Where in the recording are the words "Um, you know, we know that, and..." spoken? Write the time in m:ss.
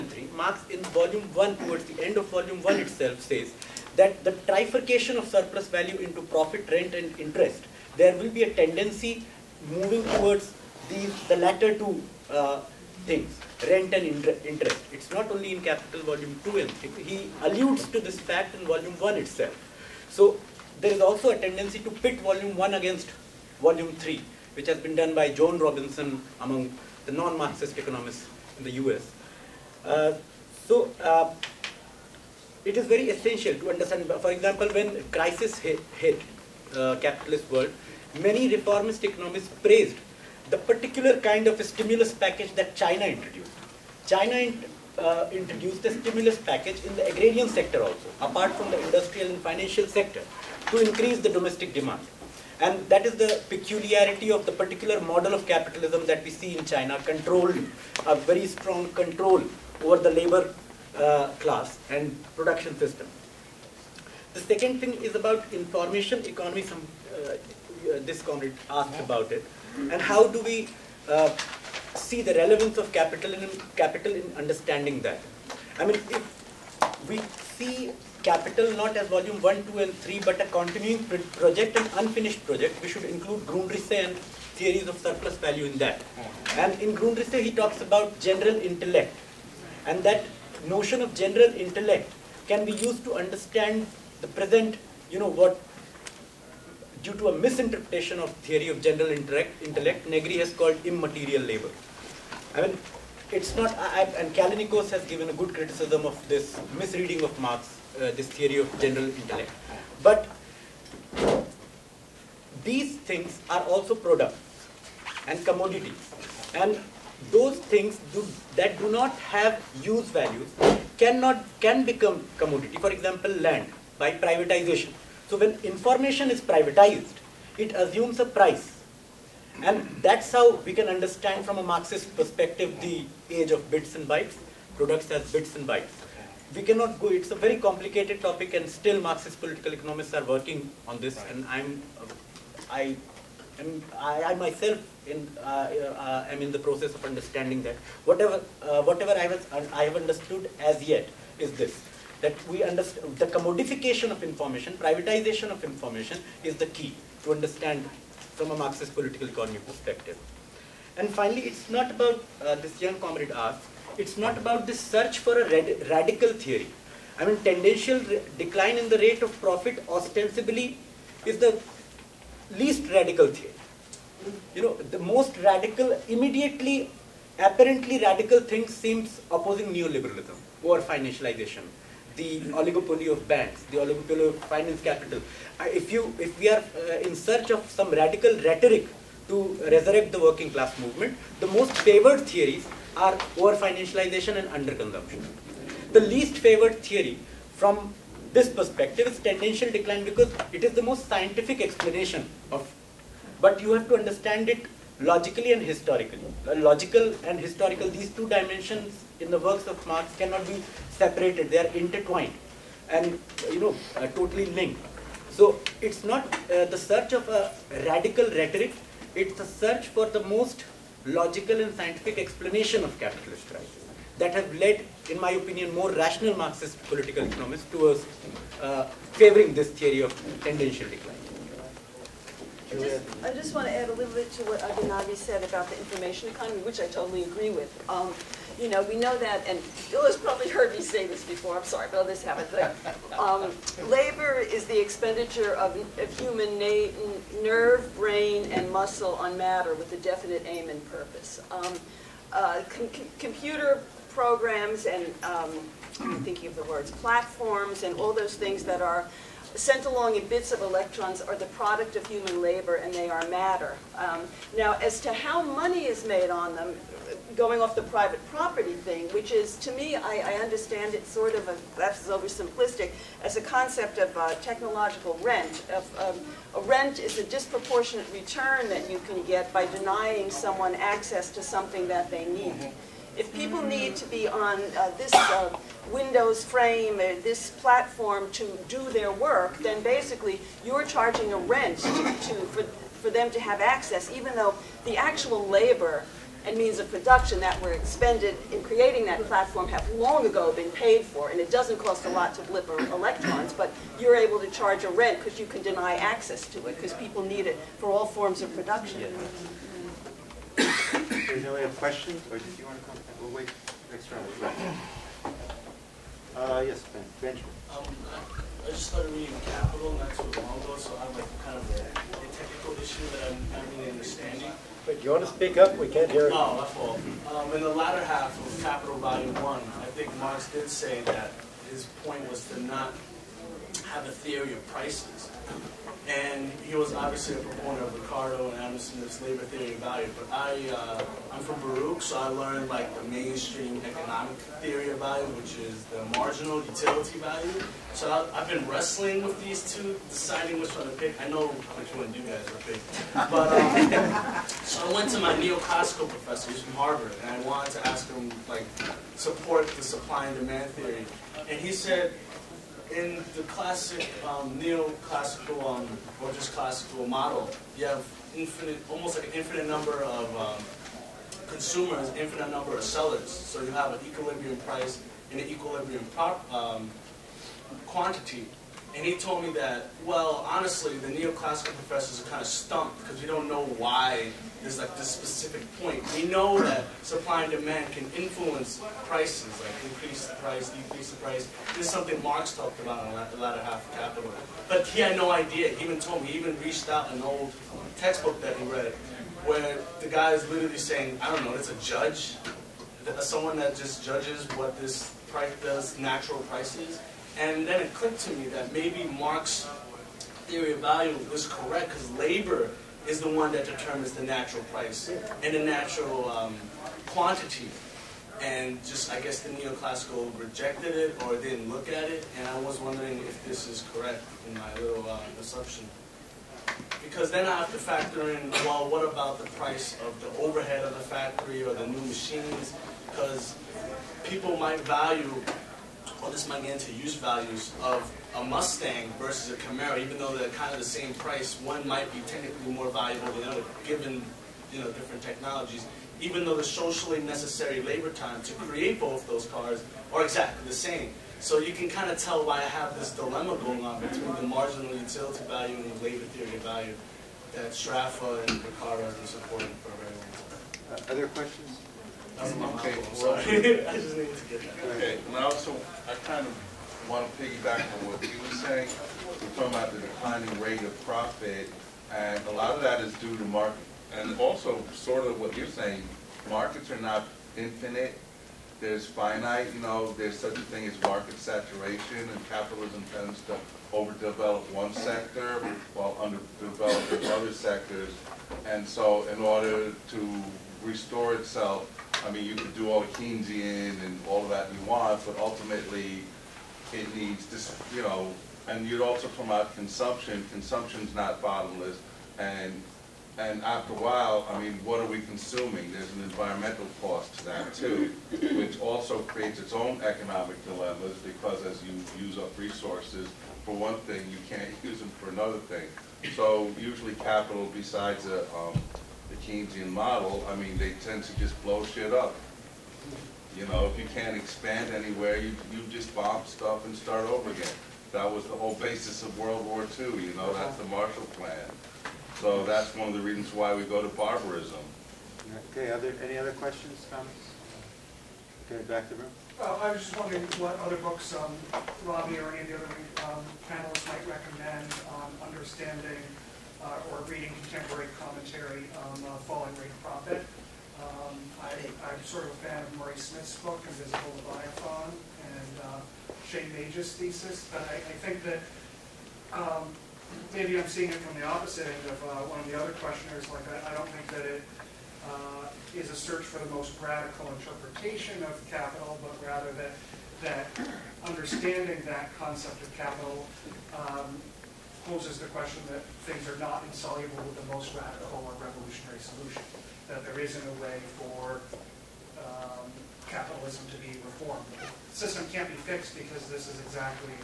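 3:57.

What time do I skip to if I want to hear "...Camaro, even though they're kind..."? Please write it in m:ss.
7:19.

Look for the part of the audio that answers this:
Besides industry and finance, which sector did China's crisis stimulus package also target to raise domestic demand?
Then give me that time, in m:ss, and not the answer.
0:47.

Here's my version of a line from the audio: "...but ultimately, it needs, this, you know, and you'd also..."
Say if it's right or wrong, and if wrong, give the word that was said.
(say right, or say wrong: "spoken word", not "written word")
right.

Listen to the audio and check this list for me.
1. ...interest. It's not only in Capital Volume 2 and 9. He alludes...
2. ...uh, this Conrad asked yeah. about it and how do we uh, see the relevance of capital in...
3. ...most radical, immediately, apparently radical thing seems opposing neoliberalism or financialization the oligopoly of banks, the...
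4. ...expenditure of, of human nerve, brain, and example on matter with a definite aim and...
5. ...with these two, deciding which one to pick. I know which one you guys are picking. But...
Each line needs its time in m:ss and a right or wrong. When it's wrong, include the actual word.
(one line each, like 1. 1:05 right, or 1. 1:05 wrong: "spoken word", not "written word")
1. 0:14 wrong: "3", not "9"
2. 1:07 right
3. 2:55 right
4. 4:04 wrong: "muscle", not "example"
5. 5:49 right.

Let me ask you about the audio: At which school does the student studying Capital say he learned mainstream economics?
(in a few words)
Baruch.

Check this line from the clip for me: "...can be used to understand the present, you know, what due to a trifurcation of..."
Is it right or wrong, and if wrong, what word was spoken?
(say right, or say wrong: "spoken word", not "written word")
wrong: "misinterpretation", not "trifurcation".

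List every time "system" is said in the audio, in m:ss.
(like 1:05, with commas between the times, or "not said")
1:02, 9:45.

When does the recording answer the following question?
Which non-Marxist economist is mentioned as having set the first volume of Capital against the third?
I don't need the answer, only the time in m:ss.
0:25.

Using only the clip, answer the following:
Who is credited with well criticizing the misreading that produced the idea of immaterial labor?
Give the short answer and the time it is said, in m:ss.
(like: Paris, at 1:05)
Callinicos, at 1:44.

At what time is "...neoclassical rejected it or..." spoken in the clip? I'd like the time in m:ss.
6:59.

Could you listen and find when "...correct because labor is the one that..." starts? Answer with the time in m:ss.
6:51.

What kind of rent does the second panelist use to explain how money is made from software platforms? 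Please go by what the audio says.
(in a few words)
technological rent.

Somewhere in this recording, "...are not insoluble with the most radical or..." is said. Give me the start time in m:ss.
9:36.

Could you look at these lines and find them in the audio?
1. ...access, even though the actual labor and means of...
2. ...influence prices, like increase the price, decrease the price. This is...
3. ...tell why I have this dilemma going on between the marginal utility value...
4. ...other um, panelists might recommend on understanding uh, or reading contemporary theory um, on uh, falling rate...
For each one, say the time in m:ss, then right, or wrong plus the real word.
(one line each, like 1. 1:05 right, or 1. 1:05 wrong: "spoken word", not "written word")
1. 4:53 right
2. 6:28 right
3. 7:32 right
4. 9:03 wrong: "commentary", not "theory".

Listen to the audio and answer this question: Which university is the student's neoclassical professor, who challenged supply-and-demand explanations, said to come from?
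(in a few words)
Harvard.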